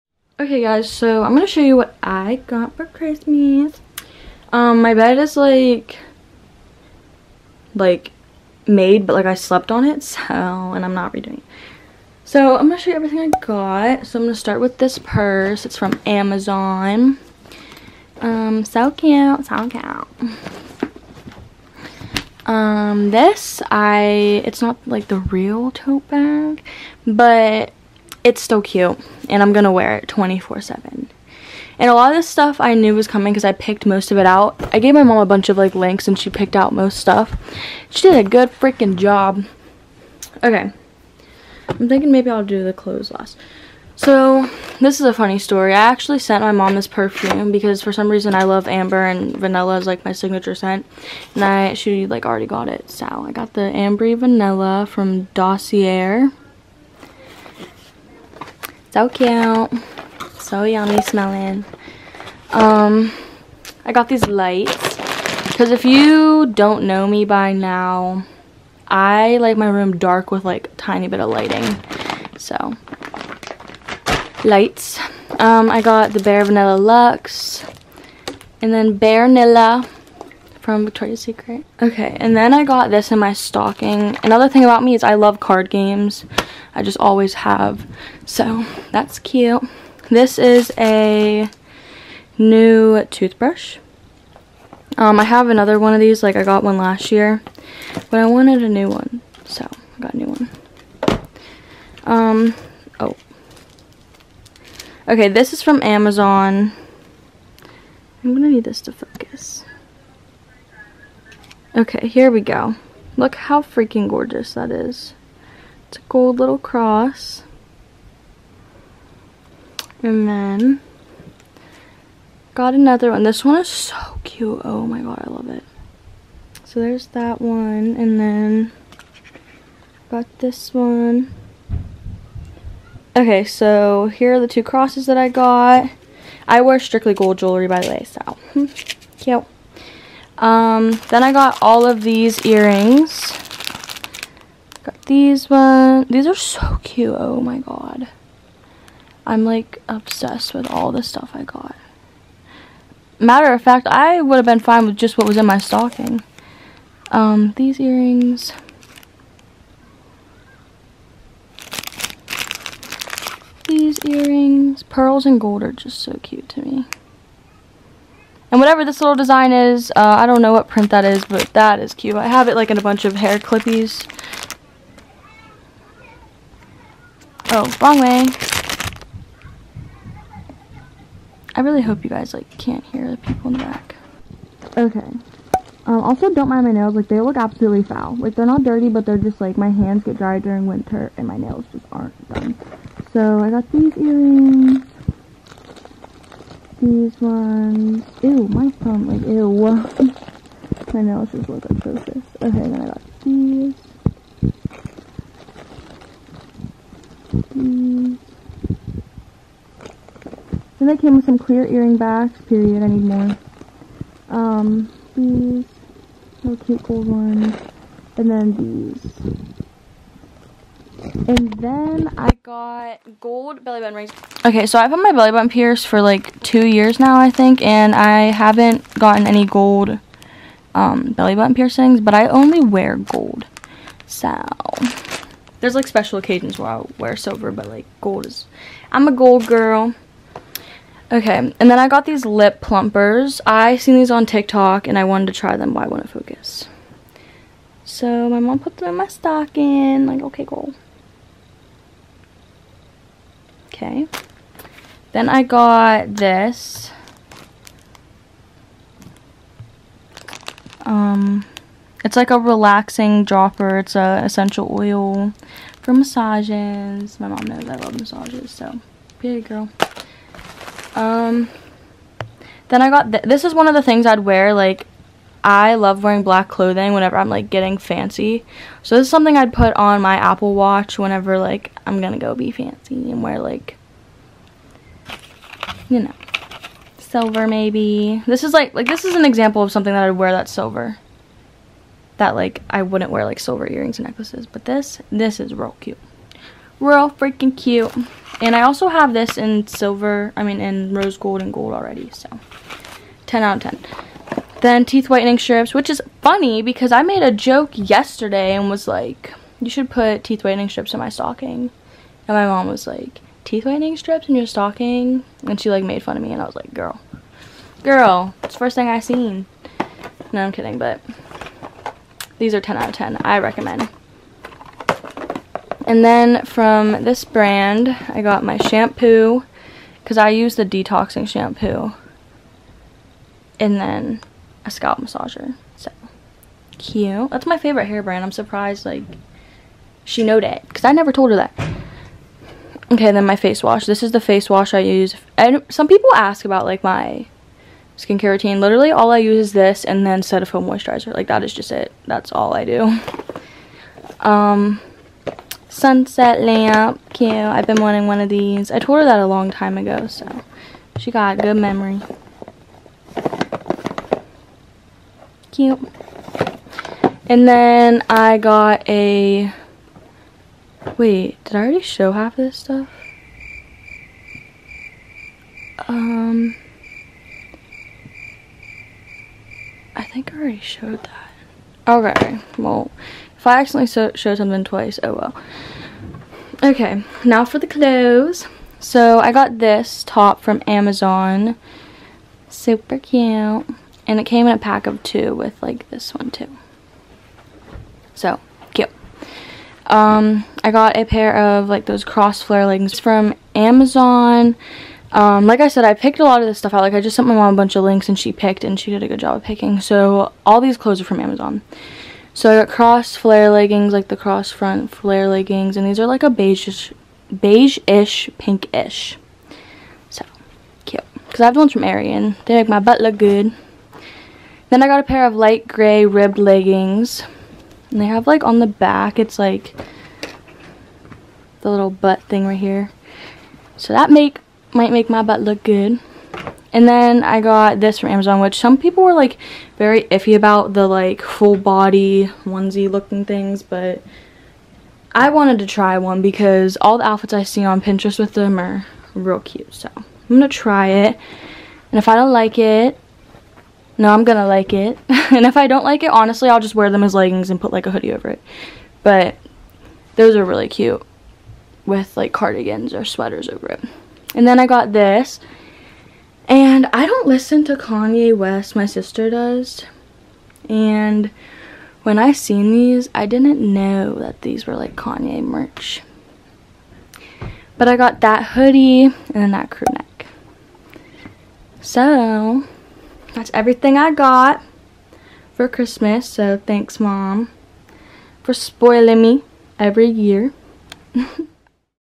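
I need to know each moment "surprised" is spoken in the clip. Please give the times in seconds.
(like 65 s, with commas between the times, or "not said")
338 s.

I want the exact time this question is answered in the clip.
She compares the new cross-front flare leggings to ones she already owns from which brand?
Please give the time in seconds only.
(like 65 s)
421 s.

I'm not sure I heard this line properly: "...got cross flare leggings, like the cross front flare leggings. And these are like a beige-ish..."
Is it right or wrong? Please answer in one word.
right.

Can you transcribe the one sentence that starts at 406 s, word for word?
Like I just sent my mom a bunch of links and she picked and she did a good job of picking.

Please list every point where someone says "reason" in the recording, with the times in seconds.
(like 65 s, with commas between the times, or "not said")
48 s.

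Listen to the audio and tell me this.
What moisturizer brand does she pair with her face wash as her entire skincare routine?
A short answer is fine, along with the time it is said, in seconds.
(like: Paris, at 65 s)
Cetaphil, at 350 s.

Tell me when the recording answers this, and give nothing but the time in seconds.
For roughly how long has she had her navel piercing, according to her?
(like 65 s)
226 s.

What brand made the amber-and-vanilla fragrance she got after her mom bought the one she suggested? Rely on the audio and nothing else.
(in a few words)
Dossier.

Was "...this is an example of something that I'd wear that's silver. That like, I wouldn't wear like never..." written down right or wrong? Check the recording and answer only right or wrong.
wrong.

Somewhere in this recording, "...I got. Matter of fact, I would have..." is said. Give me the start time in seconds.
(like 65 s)
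151 s.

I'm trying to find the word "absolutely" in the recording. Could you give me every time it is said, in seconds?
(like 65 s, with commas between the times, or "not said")
187 s.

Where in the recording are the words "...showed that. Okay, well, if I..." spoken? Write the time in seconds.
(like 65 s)
380 s.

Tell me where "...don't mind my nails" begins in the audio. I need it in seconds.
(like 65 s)
186 s.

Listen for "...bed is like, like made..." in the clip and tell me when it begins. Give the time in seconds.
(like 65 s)
4 s.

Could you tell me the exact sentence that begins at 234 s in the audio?
So, there's like special occasions where I'll wear silver, but like gold is, I'm a gold girl.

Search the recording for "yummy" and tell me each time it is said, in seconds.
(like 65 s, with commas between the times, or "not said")
60 s.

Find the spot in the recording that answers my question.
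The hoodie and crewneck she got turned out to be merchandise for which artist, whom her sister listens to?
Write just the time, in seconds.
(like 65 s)
467 s.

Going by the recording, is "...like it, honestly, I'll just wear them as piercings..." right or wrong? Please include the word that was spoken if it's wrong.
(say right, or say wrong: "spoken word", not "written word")
wrong: "leggings", not "piercings".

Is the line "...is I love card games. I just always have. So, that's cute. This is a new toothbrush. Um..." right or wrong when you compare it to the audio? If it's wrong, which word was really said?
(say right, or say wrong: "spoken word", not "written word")
right.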